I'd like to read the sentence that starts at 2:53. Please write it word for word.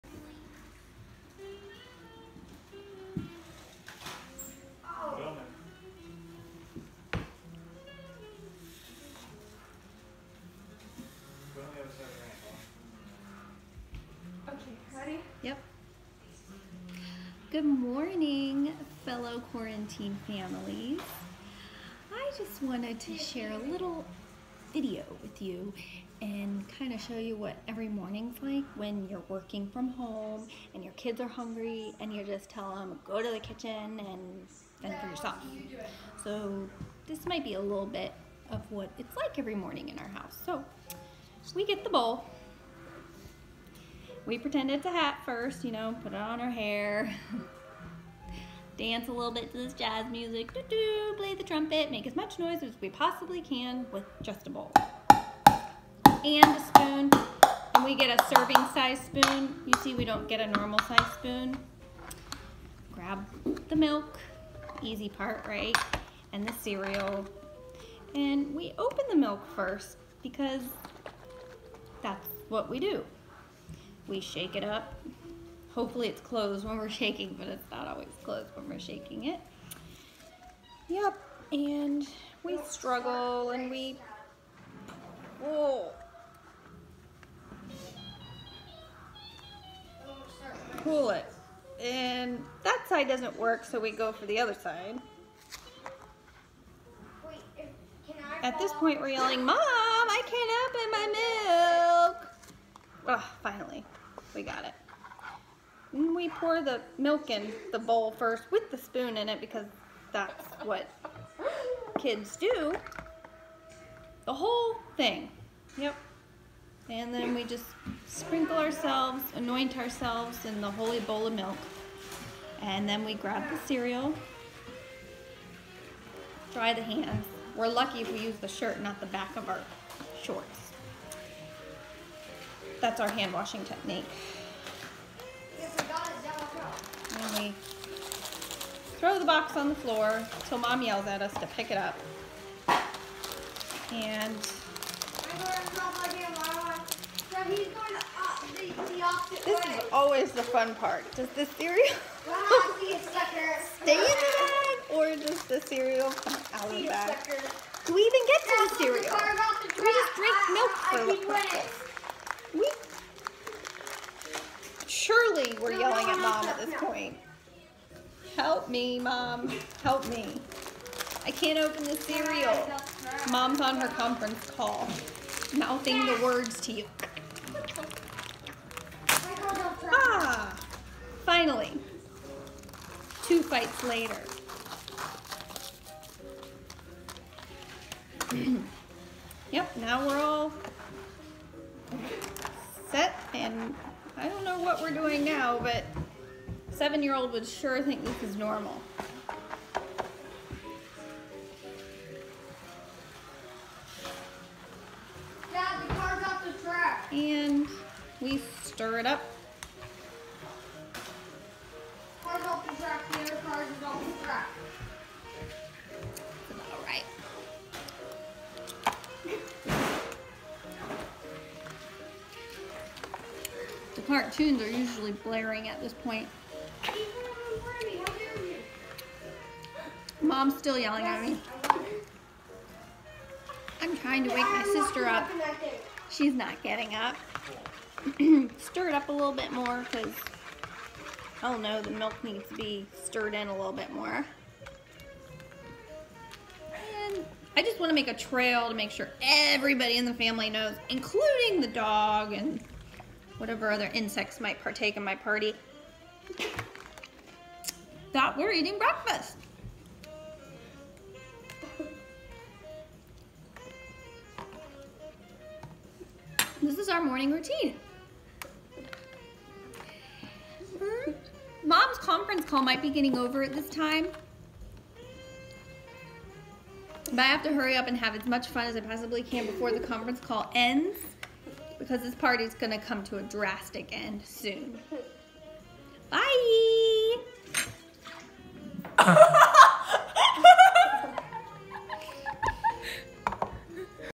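Mom's on her conference call, mouthing the words to you.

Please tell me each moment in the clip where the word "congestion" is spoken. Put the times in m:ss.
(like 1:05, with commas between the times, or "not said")
not said.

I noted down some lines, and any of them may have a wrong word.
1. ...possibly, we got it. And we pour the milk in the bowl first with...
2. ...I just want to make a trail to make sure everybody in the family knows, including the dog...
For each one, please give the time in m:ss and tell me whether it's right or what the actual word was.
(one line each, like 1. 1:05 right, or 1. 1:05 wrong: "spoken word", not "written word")
1. 1:43 wrong: "finally", not "possibly"
2. 4:07 right.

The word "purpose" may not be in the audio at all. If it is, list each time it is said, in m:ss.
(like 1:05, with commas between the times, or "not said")
2:41.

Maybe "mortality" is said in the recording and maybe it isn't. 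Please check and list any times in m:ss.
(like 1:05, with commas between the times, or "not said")
not said.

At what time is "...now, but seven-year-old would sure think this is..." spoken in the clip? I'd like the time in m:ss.
3:15.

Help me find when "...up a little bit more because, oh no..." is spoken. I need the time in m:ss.
3:58.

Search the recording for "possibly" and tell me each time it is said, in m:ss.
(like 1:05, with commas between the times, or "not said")
0:52, 4:38.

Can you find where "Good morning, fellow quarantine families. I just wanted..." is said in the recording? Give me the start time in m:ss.
0:17.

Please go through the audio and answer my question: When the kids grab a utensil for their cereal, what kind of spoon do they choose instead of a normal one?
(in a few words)
serving size spoon.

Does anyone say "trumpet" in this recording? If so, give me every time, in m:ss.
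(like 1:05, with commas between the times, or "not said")
0:51.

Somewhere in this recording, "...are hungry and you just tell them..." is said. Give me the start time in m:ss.
0:31.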